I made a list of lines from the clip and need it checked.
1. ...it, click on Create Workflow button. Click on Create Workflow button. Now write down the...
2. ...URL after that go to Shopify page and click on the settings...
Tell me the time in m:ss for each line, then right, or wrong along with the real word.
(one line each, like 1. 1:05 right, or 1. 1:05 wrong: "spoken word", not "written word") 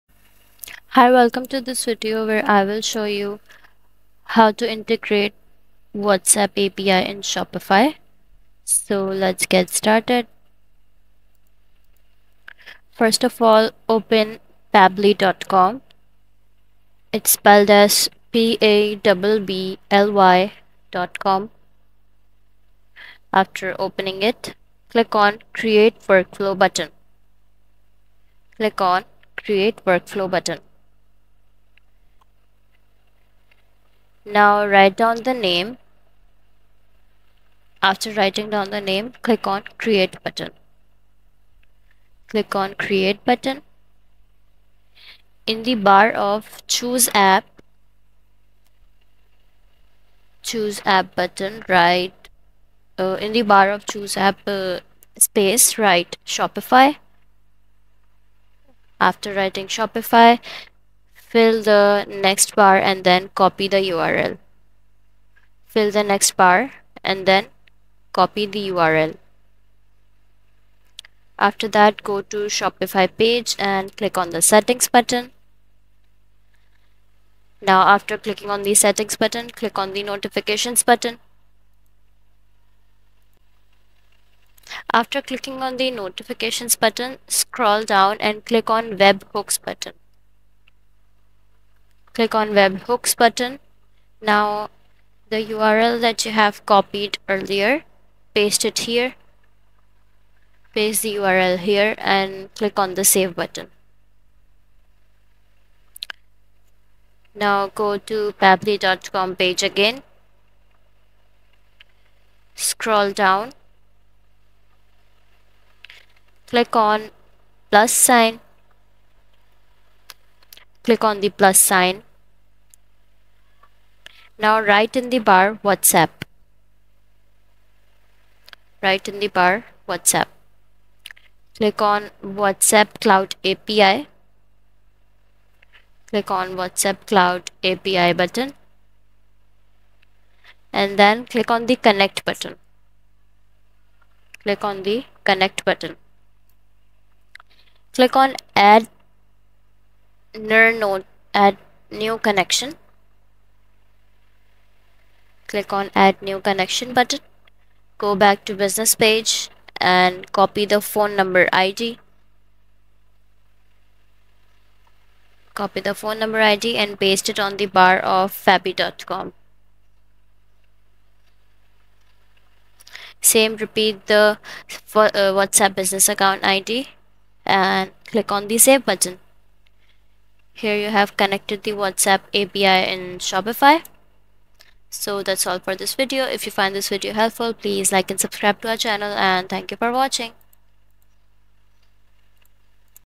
1. 0:24 right
2. 1:08 right.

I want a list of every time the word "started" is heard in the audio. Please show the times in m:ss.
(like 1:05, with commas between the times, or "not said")
0:09.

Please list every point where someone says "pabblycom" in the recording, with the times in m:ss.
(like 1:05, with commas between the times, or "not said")
0:14, 1:48, 2:48.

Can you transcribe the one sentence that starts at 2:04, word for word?
Now write in the bar WhatsApp.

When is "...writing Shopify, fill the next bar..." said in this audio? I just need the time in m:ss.
0:59.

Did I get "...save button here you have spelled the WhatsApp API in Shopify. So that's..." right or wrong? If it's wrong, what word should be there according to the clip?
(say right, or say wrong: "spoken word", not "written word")
wrong: "connected", not "spelled".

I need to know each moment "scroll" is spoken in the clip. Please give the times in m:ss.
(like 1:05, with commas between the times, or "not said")
1:27, 1:52.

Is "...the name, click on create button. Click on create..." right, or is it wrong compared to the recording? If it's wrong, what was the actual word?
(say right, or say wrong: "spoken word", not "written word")
right.